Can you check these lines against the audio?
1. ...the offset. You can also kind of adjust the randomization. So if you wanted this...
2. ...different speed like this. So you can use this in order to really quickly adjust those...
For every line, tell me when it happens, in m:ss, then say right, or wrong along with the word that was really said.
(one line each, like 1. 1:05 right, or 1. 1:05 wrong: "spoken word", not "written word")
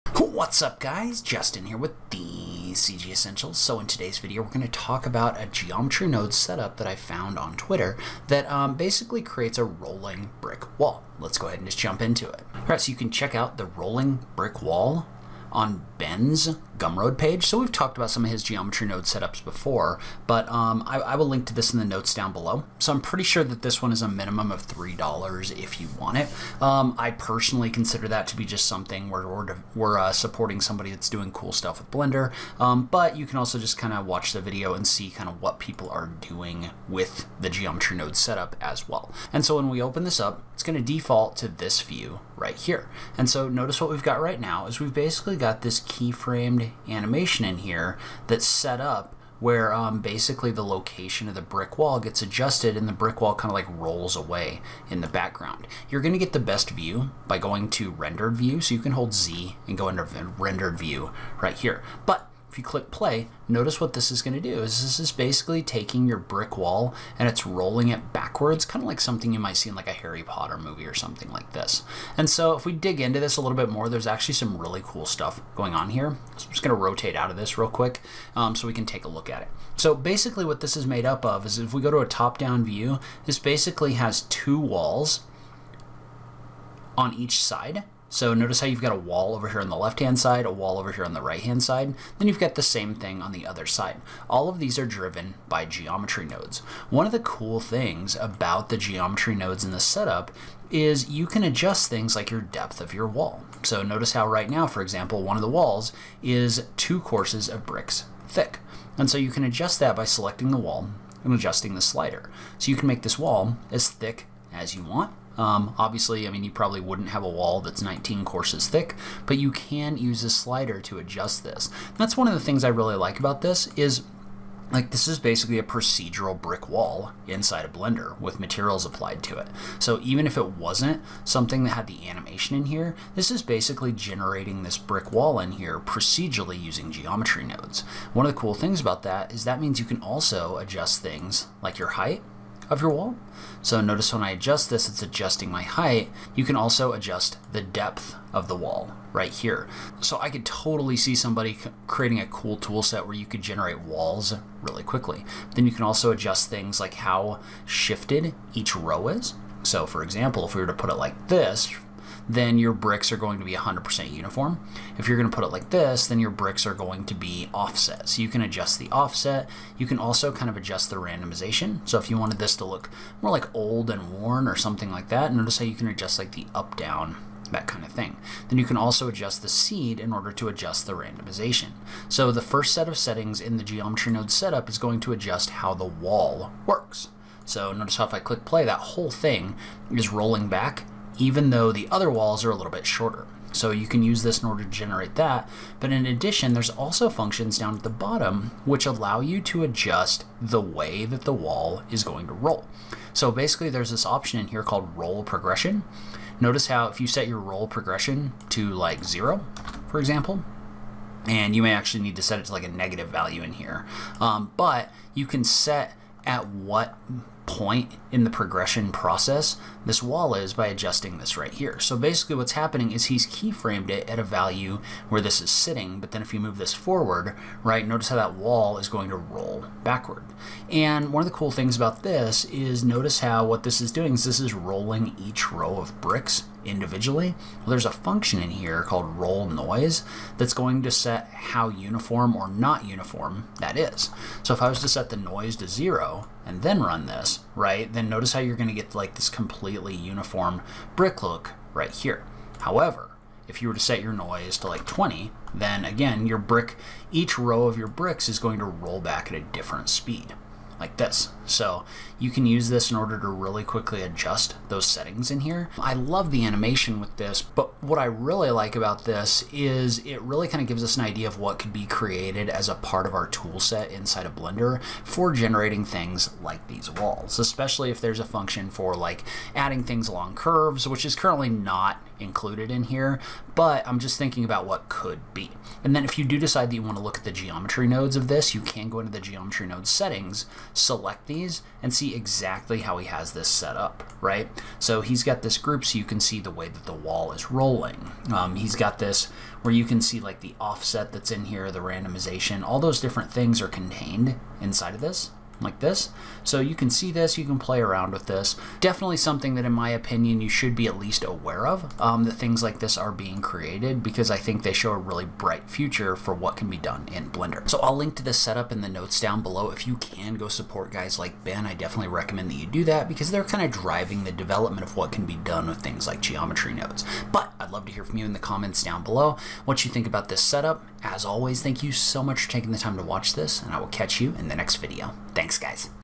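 1. 2:48 right
2. 4:19 right.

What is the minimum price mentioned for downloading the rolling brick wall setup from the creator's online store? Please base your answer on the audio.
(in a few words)
$3.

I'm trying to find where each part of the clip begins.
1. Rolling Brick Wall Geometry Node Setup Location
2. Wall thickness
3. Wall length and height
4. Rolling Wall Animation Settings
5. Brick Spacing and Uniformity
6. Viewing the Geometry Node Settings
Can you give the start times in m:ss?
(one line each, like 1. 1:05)
1. 0:12
2. 1:19
3. 2:18
4. 3:17
5. 2:39
6. 4:35.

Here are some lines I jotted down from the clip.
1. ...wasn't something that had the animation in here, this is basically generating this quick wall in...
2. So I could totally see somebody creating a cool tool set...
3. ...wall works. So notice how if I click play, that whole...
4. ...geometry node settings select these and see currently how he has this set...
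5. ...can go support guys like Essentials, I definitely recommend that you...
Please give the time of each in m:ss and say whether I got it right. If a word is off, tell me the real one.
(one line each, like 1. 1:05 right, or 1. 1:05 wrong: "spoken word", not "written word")
1. 2:10 wrong: "brick", not "quick"
2. 2:29 right
3. 3:05 right
4. 4:49 wrong: "exactly", not "currently"
5. 5:19 wrong: "Ben", not "Essentials".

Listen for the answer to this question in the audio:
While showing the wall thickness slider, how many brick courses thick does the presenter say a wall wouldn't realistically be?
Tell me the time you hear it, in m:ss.
1:57.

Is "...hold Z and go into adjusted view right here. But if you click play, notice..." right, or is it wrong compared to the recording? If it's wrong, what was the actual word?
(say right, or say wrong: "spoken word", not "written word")
wrong: "rendered", not "adjusted".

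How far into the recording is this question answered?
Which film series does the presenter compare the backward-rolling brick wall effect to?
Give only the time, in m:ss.
1:09.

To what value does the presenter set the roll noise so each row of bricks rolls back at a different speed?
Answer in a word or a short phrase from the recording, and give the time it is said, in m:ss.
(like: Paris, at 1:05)
20, at 4:14.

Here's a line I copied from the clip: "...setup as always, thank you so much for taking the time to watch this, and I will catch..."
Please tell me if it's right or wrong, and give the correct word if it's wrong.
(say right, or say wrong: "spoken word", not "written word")
right.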